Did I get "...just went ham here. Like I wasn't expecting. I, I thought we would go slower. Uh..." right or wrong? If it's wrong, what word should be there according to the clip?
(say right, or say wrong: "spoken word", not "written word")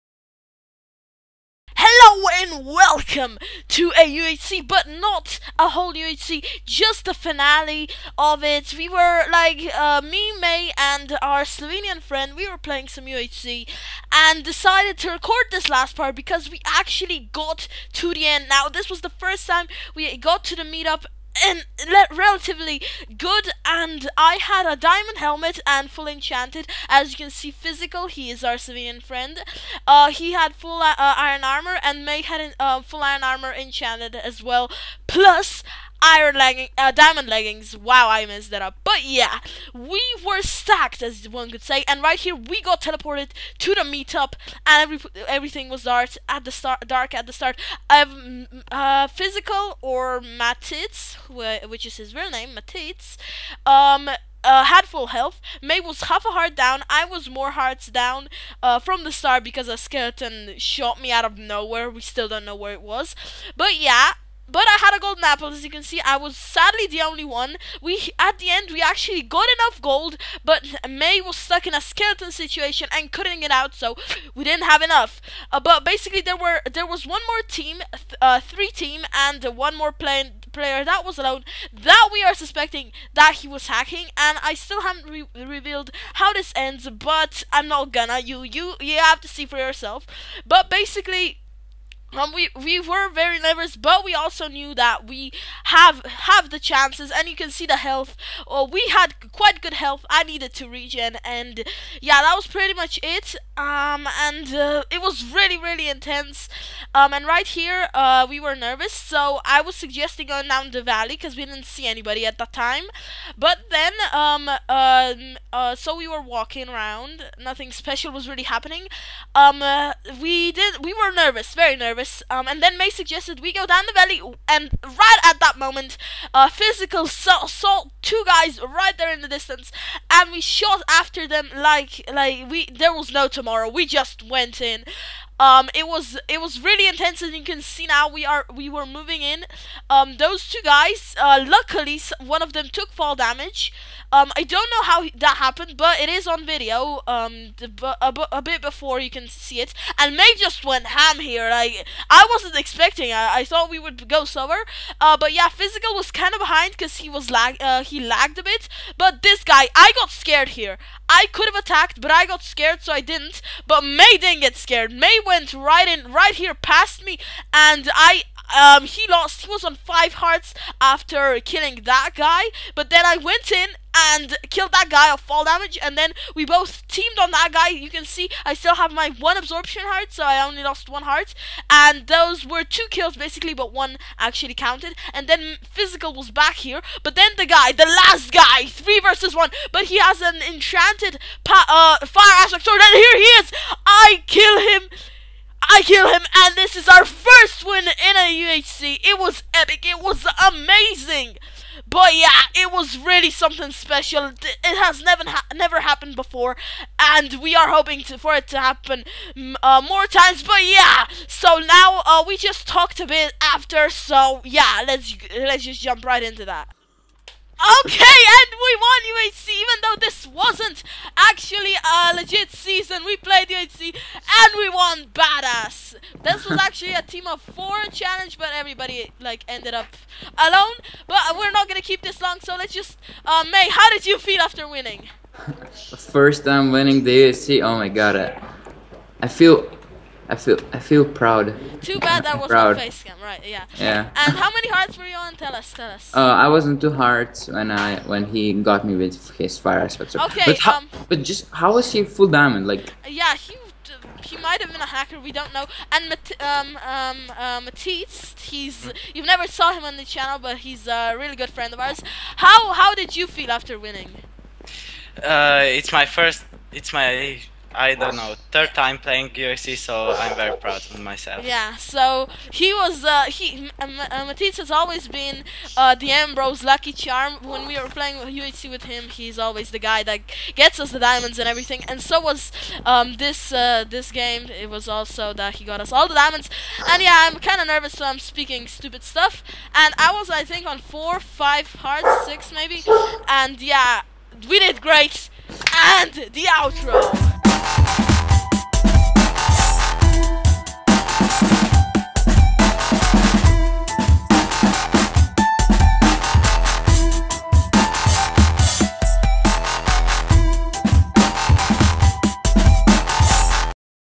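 right.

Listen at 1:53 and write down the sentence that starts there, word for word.
But then, um, uh, uh, so we were walking around.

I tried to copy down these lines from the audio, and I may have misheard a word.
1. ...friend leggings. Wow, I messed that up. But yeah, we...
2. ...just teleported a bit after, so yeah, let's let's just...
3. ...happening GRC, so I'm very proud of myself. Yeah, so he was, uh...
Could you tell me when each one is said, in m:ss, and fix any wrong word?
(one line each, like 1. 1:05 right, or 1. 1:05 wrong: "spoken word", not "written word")
1. 0:36 wrong: "diamond", not "friend"
2. 3:32 wrong: "talked", not "teleported"
3. 4:28 wrong: "playing", not "happening".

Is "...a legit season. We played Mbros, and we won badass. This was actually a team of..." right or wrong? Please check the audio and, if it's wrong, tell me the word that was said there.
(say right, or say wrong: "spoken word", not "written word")
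wrong: "UHC", not "Mbros".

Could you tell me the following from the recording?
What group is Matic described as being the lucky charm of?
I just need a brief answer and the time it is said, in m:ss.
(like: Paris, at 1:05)
Mbros, at 4:36.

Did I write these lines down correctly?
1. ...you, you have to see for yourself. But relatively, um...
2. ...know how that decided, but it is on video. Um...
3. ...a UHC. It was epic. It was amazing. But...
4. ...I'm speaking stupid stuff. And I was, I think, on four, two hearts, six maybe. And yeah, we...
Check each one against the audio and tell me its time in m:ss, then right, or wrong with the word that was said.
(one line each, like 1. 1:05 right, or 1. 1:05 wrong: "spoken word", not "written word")
1. 1:28 wrong: "basically", not "relatively"
2. 2:24 wrong: "happened", not "decided"
3. 3:18 right
4. 4:48 wrong: "five", not "two".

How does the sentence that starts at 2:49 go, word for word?
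He was on five hearts after killing that guy.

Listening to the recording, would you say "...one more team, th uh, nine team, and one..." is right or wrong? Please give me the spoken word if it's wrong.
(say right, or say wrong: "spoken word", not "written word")
wrong: "three", not "nine".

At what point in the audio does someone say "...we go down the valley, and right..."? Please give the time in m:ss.
2:03.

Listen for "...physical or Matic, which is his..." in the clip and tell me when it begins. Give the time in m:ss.
0:49.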